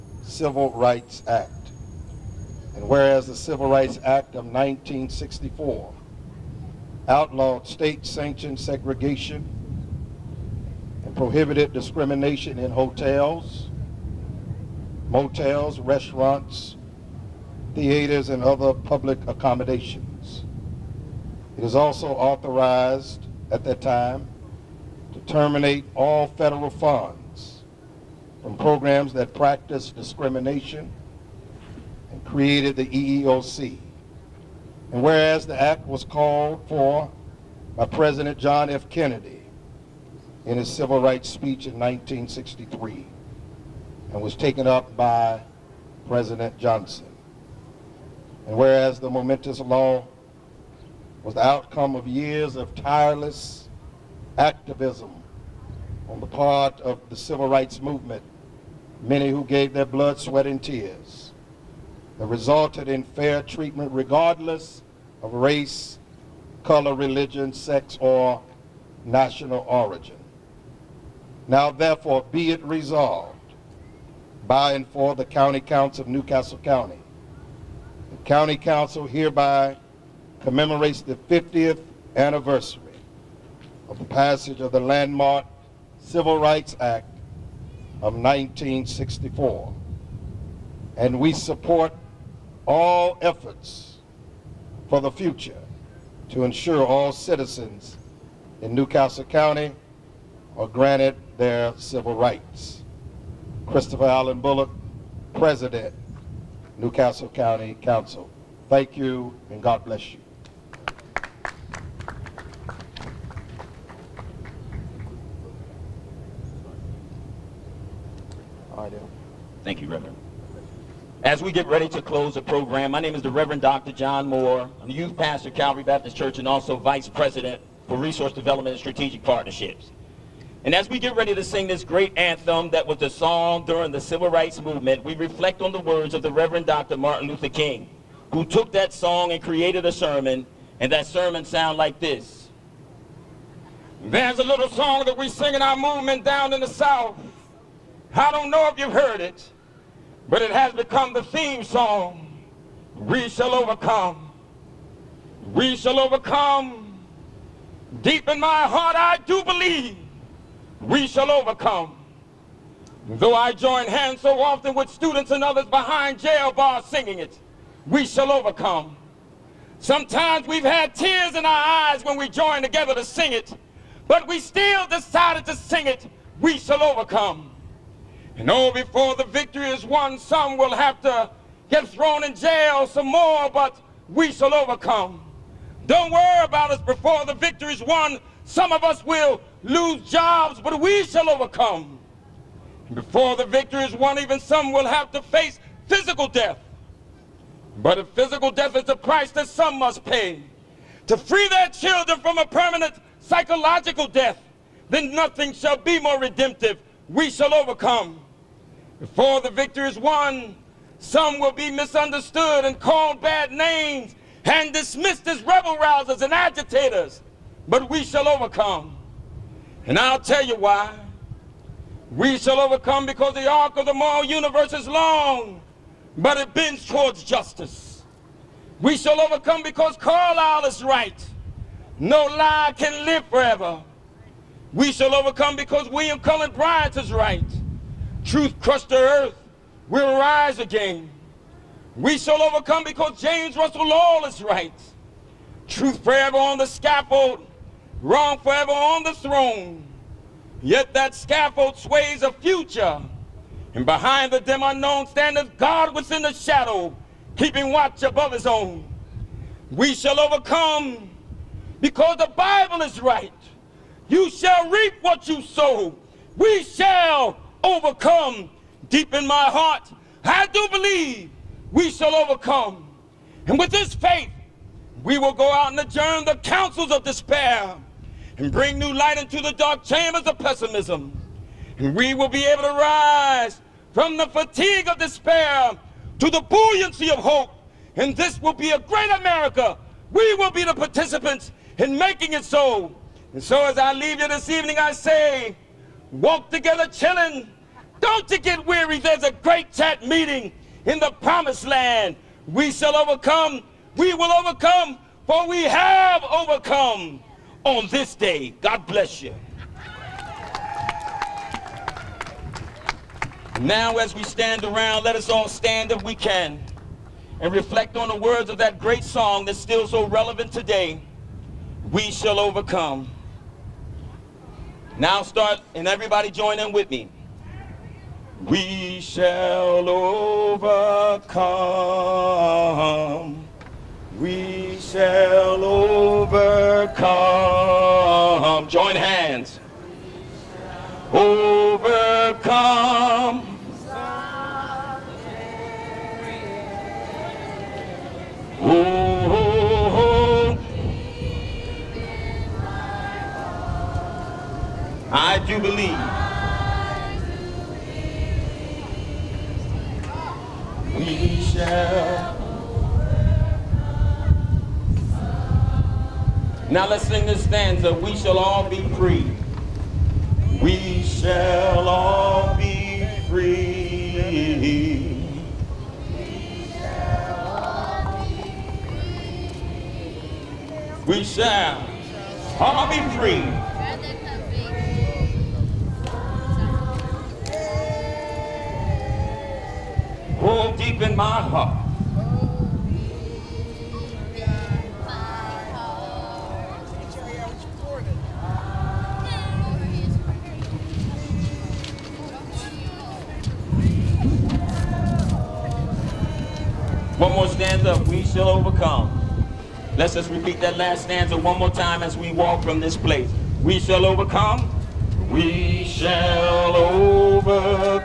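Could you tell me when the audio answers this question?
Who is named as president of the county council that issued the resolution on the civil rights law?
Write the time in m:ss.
1:43.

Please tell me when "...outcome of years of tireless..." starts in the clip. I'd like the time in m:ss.
0:51.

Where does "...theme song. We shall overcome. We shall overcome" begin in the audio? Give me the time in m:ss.
2:31.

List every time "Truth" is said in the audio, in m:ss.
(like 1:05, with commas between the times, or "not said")
3:58, 4:05.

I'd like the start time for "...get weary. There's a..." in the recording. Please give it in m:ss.
4:58.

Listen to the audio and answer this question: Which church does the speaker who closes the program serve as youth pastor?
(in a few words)
Calvary Baptist Church.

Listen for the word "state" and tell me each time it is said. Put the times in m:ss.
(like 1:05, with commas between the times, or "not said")
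0:07.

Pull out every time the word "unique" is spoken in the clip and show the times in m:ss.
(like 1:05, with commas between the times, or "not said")
not said.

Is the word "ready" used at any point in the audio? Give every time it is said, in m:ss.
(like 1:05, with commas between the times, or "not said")
2:01, 2:11.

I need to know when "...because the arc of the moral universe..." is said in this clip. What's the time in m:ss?
3:43.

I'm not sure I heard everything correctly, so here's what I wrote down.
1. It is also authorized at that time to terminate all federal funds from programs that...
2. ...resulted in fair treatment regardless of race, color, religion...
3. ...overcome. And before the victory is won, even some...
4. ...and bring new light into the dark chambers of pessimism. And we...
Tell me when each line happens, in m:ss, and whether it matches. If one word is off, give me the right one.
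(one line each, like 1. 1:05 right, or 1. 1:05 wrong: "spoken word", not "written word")
1. 0:21 right
2. 1:02 right
3. 3:11 right
4. 4:38 right.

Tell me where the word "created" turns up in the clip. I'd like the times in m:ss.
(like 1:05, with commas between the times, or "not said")
0:32, 2:19.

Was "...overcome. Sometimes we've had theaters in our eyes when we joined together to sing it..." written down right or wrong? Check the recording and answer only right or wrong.
wrong.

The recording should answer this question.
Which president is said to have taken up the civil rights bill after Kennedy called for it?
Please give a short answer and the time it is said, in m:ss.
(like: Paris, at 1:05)
President Johnson, at 0:46.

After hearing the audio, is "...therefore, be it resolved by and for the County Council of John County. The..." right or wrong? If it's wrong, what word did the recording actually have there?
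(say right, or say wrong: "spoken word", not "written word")
wrong: "Newcastle", not "John".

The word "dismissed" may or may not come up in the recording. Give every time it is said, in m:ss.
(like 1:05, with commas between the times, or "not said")
3:34.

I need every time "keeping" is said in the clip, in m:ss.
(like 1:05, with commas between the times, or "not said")
4:17.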